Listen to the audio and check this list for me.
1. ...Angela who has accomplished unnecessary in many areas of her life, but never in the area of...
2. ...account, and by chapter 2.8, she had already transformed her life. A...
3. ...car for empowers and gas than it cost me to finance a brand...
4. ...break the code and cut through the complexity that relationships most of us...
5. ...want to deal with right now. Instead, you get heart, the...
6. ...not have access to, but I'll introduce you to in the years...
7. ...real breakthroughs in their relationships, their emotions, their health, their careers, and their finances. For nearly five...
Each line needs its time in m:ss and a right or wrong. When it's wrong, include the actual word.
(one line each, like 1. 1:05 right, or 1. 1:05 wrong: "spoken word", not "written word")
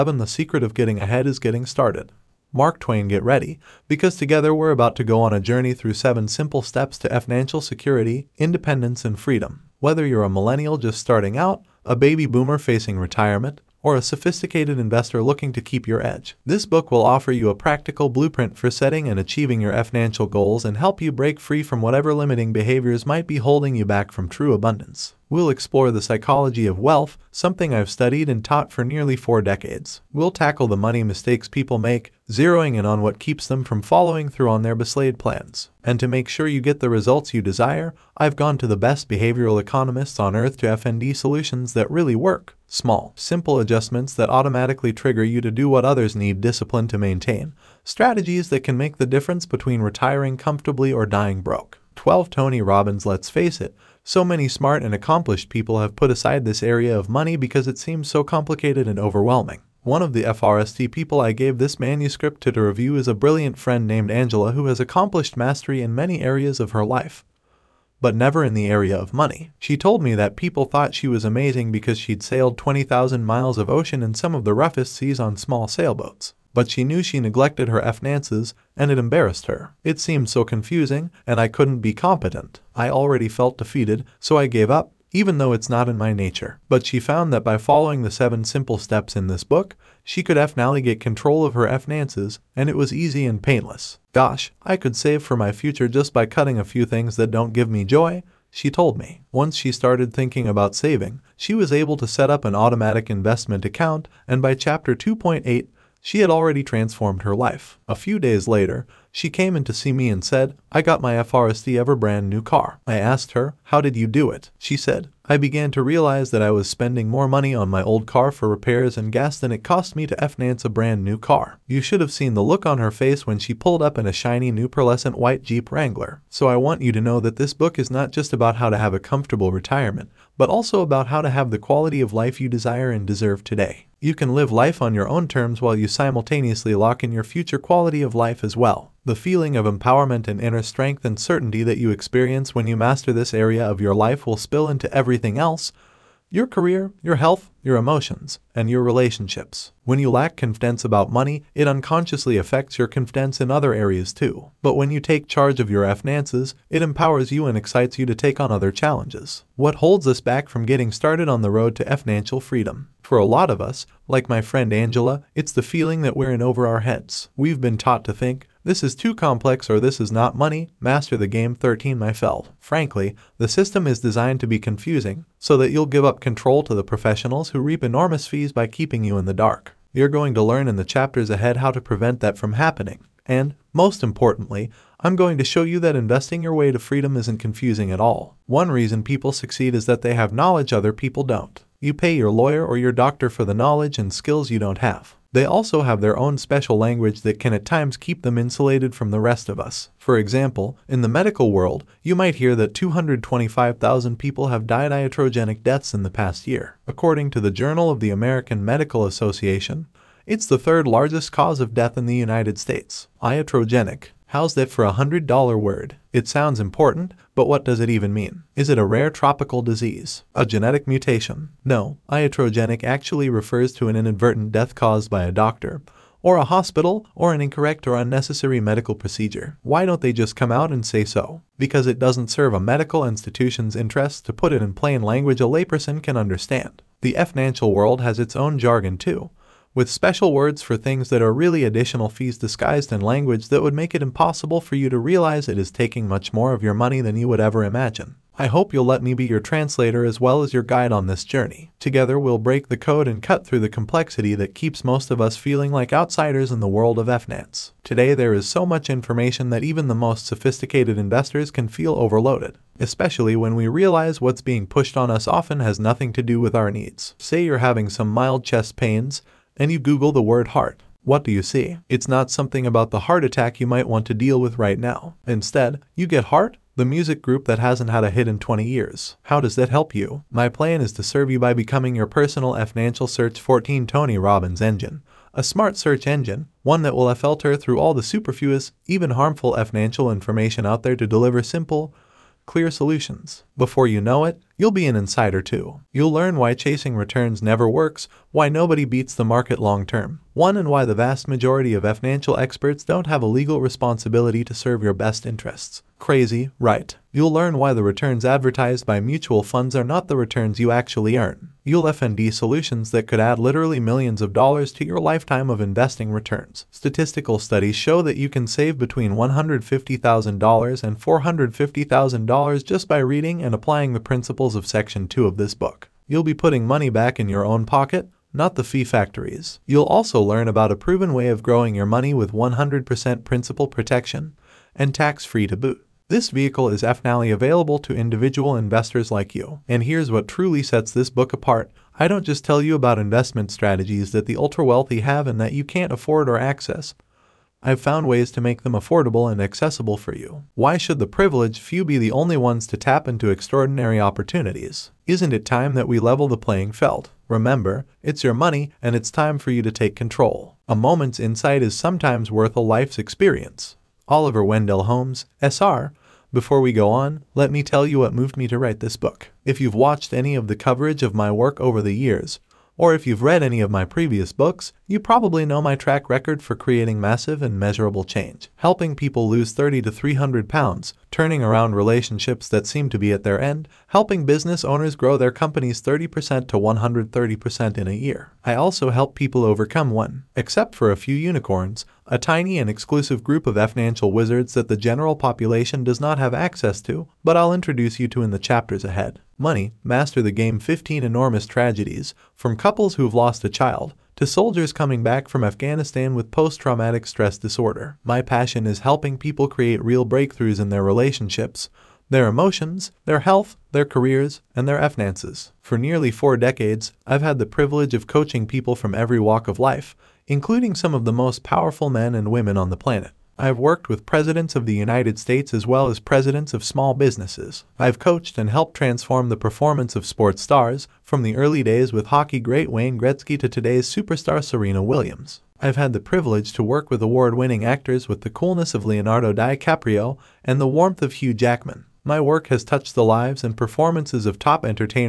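1. 1:04 wrong: "mastery", not "unnecessary"
2. 1:43 right
3. 1:58 wrong: "repairs", not "empowers"
4. 4:12 wrong: "keeps", not "relationships"
5. 4:33 right
6. 6:35 wrong: "chapters", not "years"
7. 6:49 wrong: "four", not "five".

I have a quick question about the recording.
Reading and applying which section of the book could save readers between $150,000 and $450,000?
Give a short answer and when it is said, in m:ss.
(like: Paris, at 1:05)
Section 2, at 5:24.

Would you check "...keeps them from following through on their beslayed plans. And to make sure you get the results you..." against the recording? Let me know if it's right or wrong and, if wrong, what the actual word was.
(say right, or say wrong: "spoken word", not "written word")
right.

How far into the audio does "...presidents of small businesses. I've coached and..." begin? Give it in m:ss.
7:05.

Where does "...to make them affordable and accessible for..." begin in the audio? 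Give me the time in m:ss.
5:48.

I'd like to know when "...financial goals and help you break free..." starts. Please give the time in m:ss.
0:19.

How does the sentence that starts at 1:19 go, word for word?
It seemed so confusing and I couldn't be competent.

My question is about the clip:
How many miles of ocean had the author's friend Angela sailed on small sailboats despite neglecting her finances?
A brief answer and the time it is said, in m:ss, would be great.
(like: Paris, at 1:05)
20,000, at 1:12.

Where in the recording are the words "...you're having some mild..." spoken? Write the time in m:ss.
4:27.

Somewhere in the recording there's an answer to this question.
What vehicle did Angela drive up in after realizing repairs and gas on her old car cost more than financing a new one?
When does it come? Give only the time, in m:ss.
2:05.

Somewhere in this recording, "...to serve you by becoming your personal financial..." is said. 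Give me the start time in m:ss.
4:40.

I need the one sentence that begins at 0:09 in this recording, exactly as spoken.
Whether you're a millennial just starting out, a baby boomer facing retirement, or a sophisticated investor looking to keep your edge.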